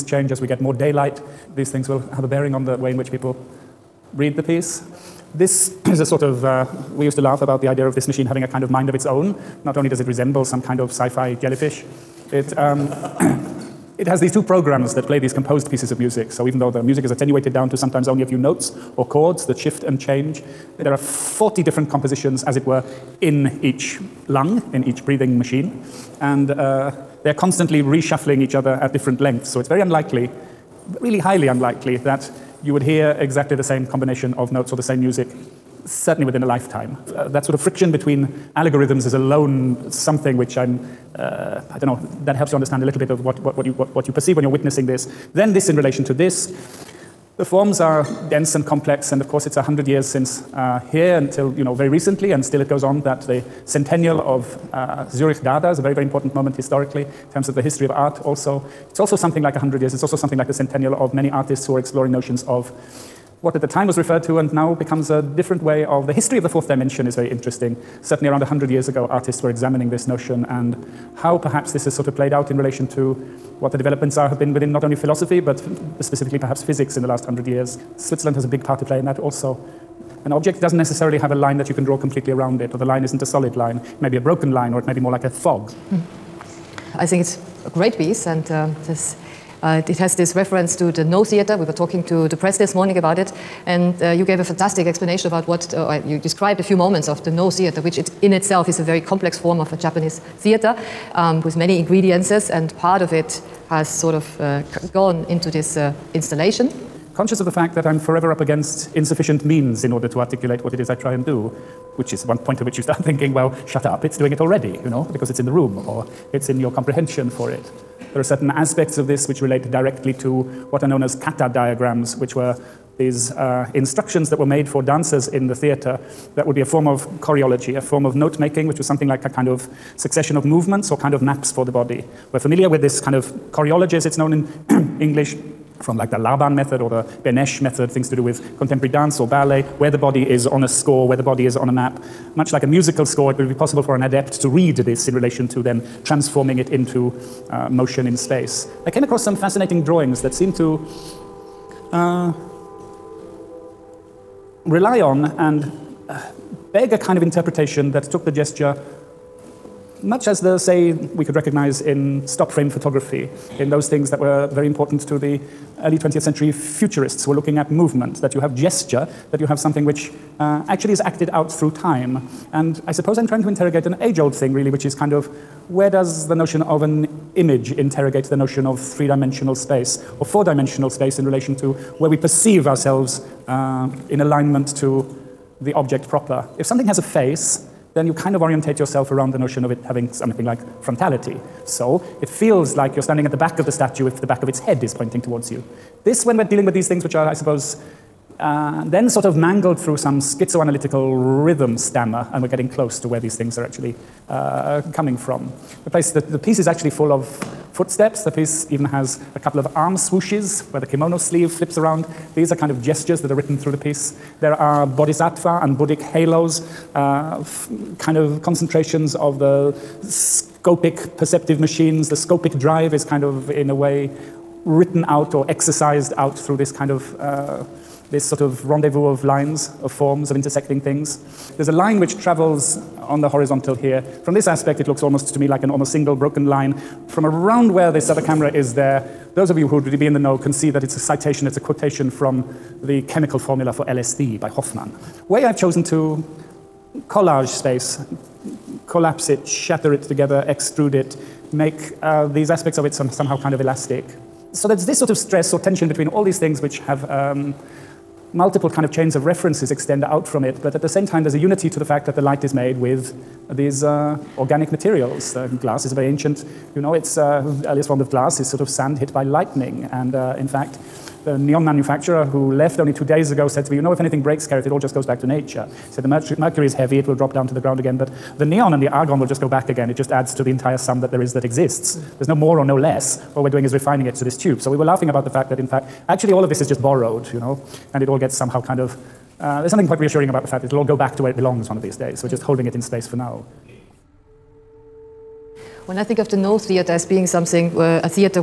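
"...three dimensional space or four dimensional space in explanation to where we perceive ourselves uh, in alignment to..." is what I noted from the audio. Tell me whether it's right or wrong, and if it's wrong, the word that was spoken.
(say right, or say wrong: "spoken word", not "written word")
wrong: "relation", not "explanation".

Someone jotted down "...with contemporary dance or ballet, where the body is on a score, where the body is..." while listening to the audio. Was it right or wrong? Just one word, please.
right.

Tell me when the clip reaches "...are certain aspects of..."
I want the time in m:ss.
1:58.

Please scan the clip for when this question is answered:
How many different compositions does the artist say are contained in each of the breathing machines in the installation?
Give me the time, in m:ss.
0:20.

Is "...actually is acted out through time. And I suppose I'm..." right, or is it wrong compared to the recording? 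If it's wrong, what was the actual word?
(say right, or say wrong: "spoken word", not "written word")
right.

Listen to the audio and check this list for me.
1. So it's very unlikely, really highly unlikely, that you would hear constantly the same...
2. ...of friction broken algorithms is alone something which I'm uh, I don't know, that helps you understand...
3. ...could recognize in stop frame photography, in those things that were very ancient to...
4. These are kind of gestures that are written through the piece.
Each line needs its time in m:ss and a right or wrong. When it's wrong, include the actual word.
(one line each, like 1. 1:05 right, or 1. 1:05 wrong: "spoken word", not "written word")
1. 0:29 wrong: "exactly", not "constantly"
2. 0:37 wrong: "between", not "broken"
3. 2:41 wrong: "important", not "ancient"
4. 3:32 right.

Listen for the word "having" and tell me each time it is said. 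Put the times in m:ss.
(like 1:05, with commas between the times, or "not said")
0:08, 3:09.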